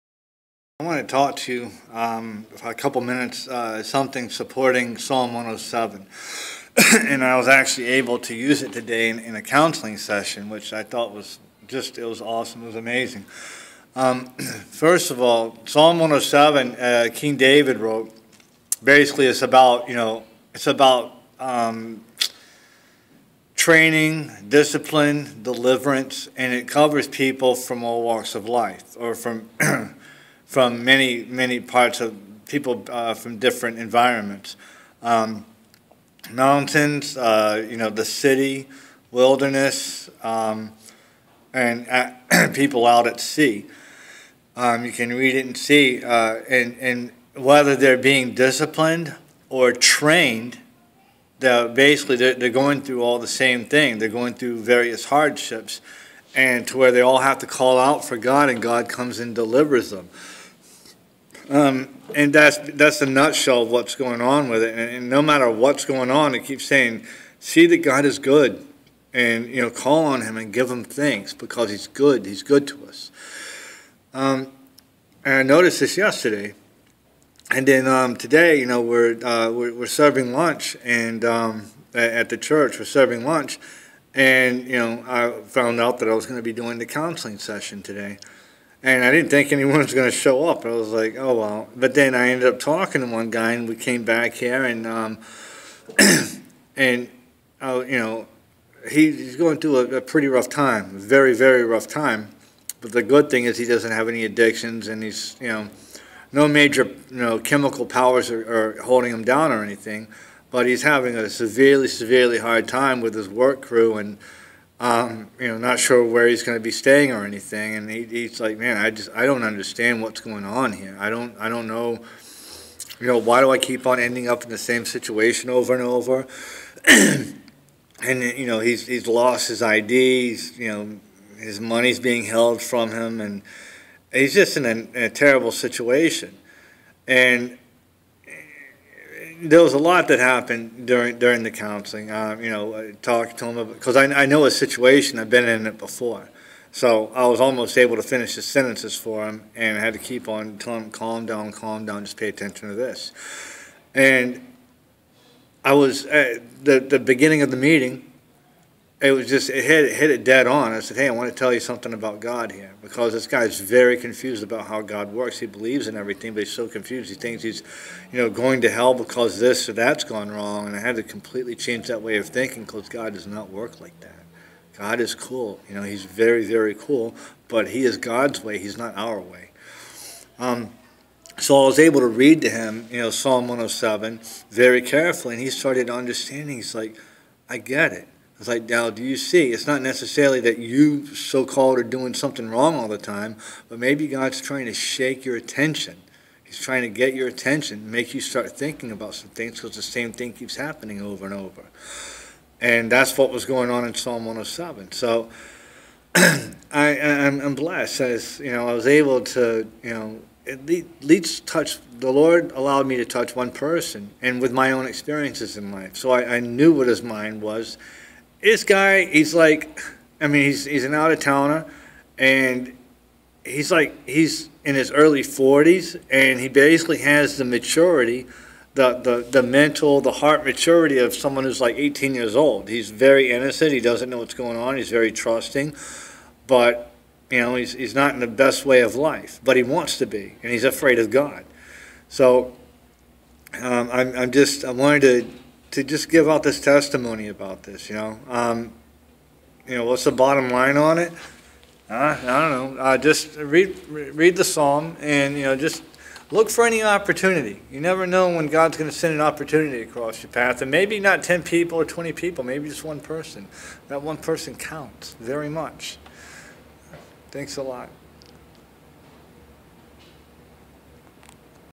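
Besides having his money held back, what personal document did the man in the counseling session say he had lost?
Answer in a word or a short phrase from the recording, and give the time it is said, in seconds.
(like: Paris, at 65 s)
His ID, at 129 s.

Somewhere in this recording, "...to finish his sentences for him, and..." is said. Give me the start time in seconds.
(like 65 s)
147 s.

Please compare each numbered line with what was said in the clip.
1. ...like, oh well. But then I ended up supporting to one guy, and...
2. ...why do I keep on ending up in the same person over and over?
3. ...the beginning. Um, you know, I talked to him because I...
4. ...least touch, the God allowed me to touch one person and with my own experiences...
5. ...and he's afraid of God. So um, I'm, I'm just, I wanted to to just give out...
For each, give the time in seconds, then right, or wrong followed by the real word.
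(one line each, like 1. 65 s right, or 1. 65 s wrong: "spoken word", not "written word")
1. 90 s wrong: "talking", not "supporting"
2. 123 s wrong: "situation", not "person"
3. 141 s wrong: "counseling", not "beginning"
4. 211 s wrong: "Lord", not "God"
5. 240 s right.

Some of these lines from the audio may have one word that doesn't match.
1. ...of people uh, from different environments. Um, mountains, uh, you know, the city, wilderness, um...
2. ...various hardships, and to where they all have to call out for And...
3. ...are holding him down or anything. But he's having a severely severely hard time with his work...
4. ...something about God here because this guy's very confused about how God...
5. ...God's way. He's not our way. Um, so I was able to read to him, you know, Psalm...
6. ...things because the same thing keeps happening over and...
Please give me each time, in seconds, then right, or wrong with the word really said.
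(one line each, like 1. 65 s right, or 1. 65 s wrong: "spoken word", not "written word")
1. 32 s right
2. 54 s wrong: "God", not "And"
3. 108 s right
4. 161 s right
5. 177 s right
6. 199 s right.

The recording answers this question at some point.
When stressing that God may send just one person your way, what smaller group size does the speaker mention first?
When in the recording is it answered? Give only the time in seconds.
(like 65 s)
261 s.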